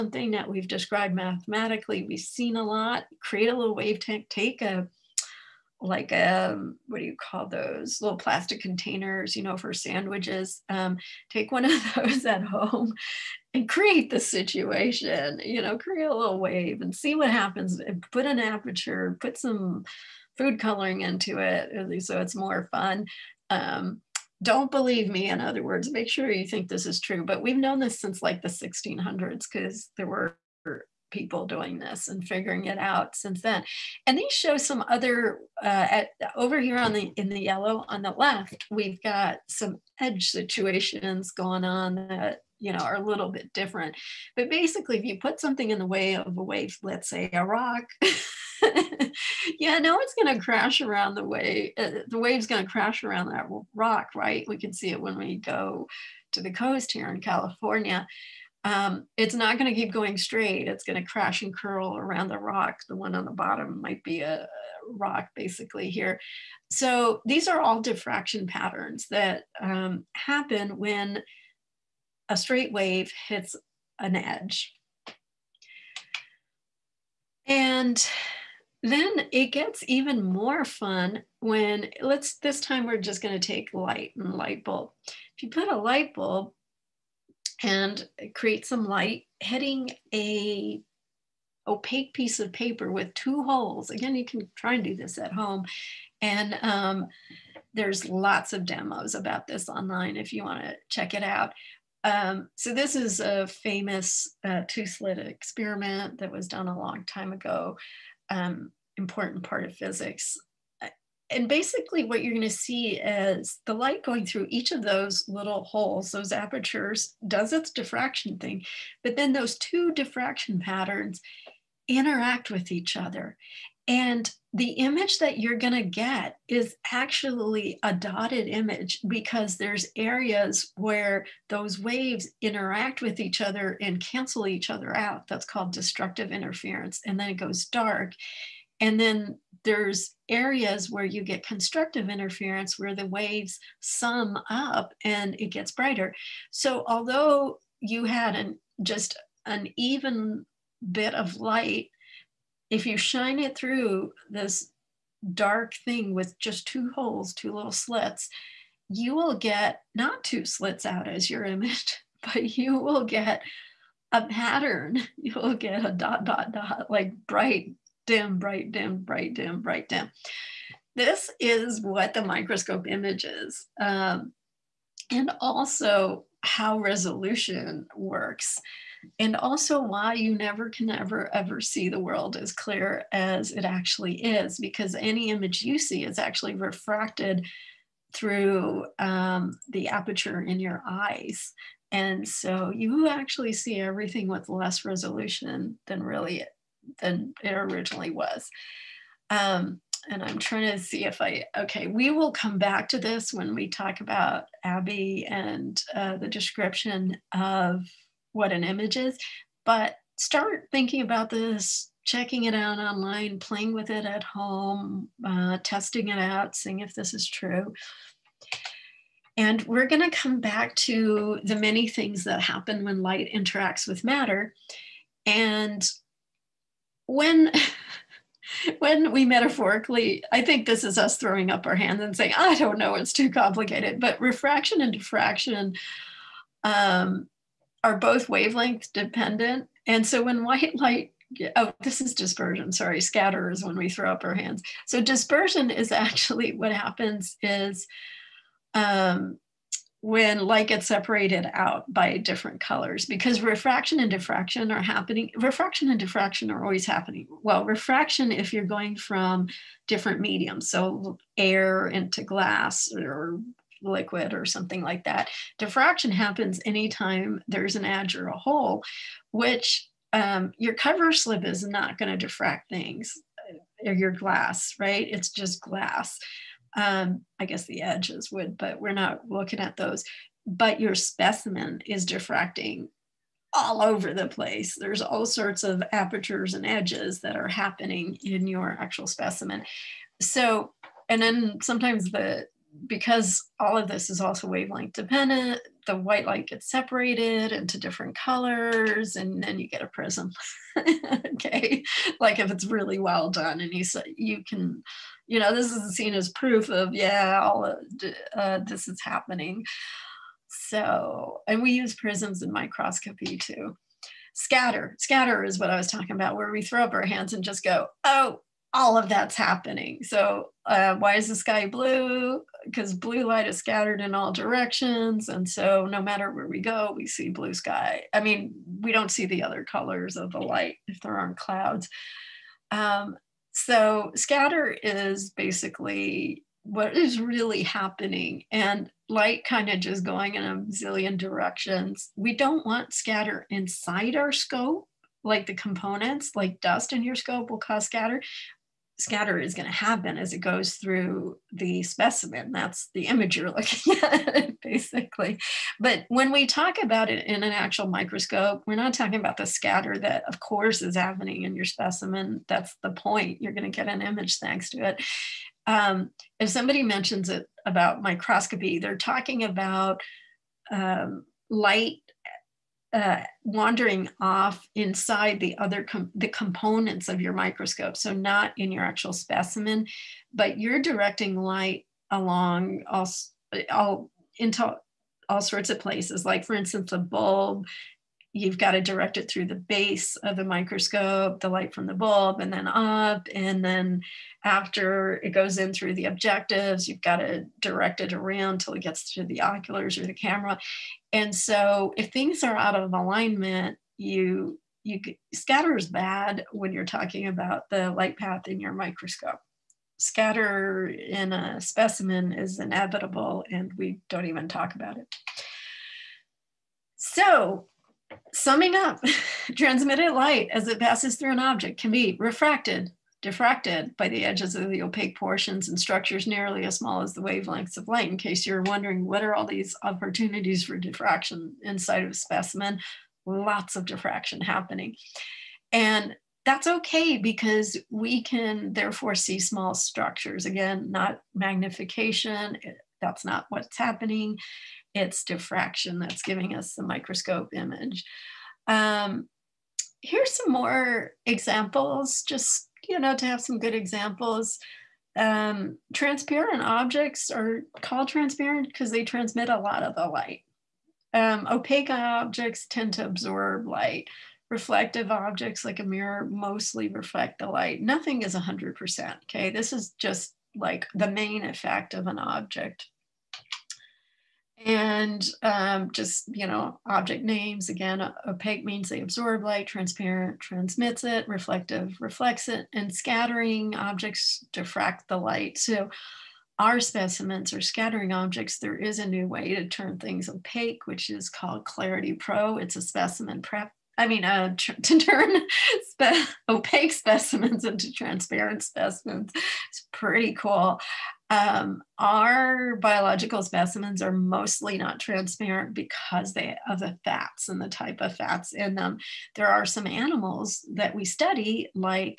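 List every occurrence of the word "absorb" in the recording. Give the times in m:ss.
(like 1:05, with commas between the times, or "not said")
7:43, 7:59.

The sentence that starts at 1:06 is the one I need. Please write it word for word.
So these are all diffraction patterns that um, happen when a straight wave hits an edge.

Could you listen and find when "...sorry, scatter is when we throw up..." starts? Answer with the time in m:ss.
4:02.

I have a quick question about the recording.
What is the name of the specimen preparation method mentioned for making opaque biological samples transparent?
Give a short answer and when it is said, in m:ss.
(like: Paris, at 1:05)
Clarity pro, at 8:11.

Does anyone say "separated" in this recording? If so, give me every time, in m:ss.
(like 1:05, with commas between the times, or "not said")
4:10, 4:56.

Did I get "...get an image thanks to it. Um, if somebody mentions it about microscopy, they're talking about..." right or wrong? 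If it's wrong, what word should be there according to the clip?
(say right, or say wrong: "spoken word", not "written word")
right.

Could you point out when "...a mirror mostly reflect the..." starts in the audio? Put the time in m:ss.
7:45.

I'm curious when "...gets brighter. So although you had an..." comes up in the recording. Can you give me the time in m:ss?
2:25.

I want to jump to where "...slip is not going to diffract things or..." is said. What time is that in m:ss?
4:31.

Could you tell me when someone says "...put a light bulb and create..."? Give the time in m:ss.
1:25.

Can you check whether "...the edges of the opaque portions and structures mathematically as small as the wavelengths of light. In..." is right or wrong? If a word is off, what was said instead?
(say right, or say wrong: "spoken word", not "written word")
wrong: "nearly", not "mathematically".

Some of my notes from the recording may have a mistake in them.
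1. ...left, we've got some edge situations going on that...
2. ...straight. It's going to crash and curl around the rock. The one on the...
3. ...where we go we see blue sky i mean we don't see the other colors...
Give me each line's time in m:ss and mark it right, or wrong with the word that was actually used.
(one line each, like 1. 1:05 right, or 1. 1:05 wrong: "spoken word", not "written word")
1. 0:38 right
2. 1:00 right
3. 5:26 right.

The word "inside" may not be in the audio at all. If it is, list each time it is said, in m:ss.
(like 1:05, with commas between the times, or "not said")
5:43, 6:14, 7:11.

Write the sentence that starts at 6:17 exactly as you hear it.
So not in your actual specimen, but you're directing light along all, all into all sorts of places.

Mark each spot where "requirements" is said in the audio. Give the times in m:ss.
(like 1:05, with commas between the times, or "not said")
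not said.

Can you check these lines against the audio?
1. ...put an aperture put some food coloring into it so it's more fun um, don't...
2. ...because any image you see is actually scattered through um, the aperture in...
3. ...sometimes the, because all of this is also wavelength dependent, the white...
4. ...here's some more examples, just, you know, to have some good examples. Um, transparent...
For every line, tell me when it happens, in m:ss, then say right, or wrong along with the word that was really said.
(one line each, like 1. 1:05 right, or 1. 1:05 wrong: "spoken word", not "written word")
1. 0:18 right
2. 3:04 wrong: "refracted", not "scattered"
3. 4:51 right
4. 7:30 right.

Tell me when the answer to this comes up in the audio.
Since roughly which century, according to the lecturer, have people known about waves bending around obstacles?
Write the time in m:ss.
0:28.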